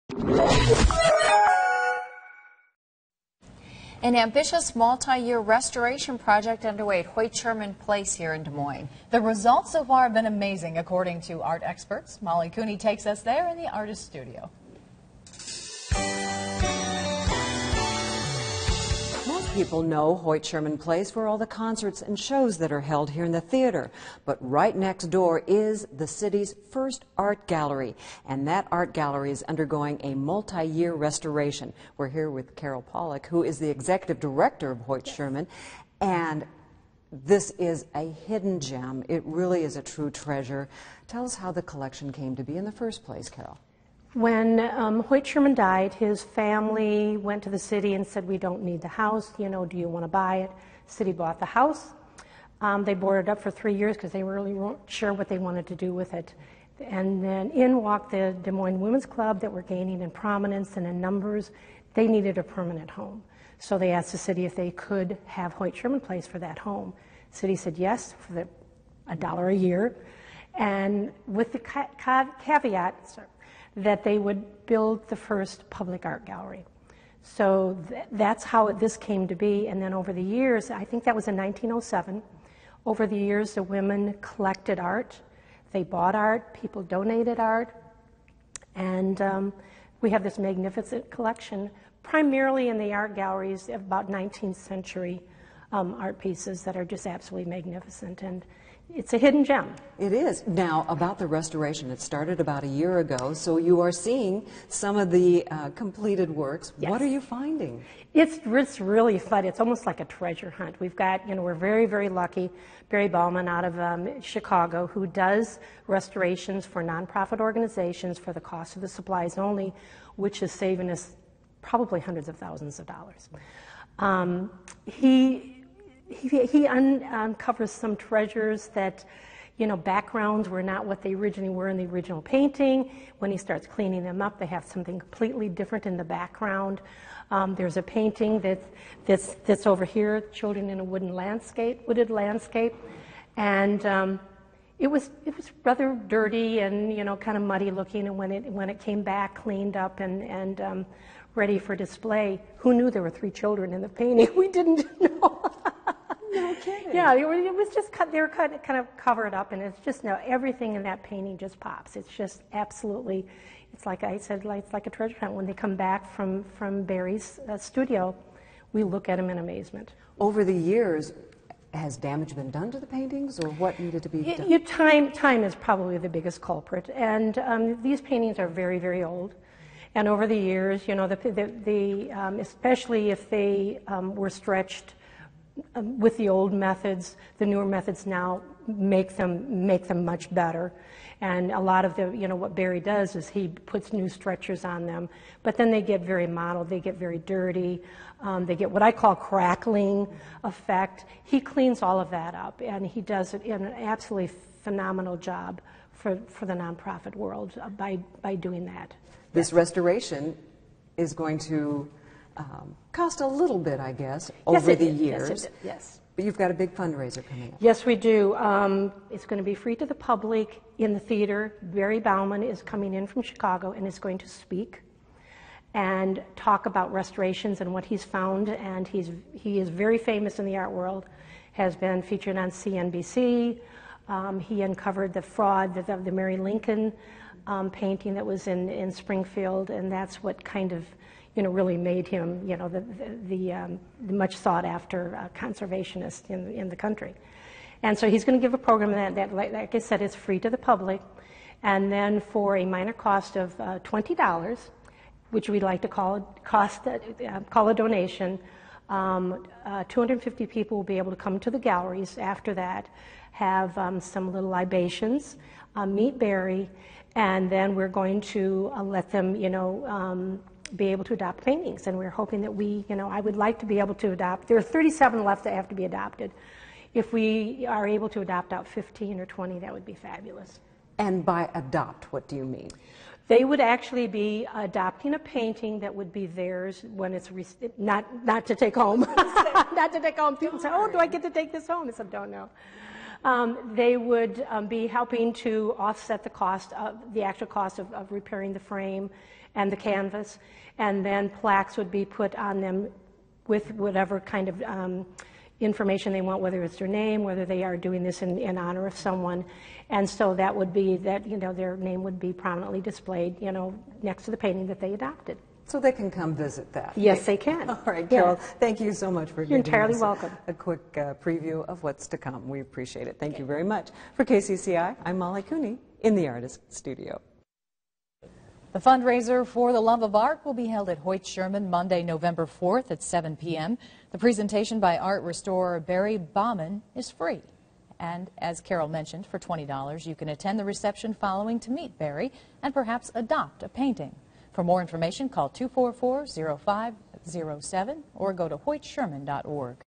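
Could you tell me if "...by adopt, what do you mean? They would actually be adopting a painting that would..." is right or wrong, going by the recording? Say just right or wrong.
right.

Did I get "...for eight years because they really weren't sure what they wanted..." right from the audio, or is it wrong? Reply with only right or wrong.
wrong.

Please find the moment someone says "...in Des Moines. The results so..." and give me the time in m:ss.
0:08.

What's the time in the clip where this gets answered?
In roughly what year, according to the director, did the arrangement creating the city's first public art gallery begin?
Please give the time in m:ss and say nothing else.
1:21.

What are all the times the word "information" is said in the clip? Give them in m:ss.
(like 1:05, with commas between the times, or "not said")
5:05, 5:44.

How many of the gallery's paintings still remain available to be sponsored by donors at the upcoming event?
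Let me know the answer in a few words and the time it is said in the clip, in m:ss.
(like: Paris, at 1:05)
37, at 4:34.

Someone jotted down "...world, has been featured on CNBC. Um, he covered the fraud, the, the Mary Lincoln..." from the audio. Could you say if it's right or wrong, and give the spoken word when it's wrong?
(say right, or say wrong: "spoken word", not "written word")
wrong: "uncovered", not "covered".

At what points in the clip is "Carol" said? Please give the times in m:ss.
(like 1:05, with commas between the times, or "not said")
0:32, 0:43, 5:18, 5:38.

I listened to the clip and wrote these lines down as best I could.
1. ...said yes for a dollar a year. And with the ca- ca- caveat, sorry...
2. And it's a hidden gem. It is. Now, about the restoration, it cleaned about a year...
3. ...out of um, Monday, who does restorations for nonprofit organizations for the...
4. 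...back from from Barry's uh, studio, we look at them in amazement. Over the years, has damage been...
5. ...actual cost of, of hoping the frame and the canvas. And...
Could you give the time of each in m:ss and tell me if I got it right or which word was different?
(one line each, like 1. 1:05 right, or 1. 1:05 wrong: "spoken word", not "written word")
1. 1:07 right
2. 1:38 wrong: "started", not "cleaned"
3. 1:53 wrong: "Chicago", not "Monday"
4. 2:45 right
5. 4:57 wrong: "repairing", not "hoping".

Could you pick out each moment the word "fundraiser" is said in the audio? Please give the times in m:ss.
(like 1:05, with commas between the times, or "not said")
3:36, 5:28.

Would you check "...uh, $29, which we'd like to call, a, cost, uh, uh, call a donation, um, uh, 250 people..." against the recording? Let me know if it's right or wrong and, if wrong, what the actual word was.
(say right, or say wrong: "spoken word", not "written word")
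wrong: "20", not "29".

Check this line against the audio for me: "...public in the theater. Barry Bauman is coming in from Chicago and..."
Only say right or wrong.
right.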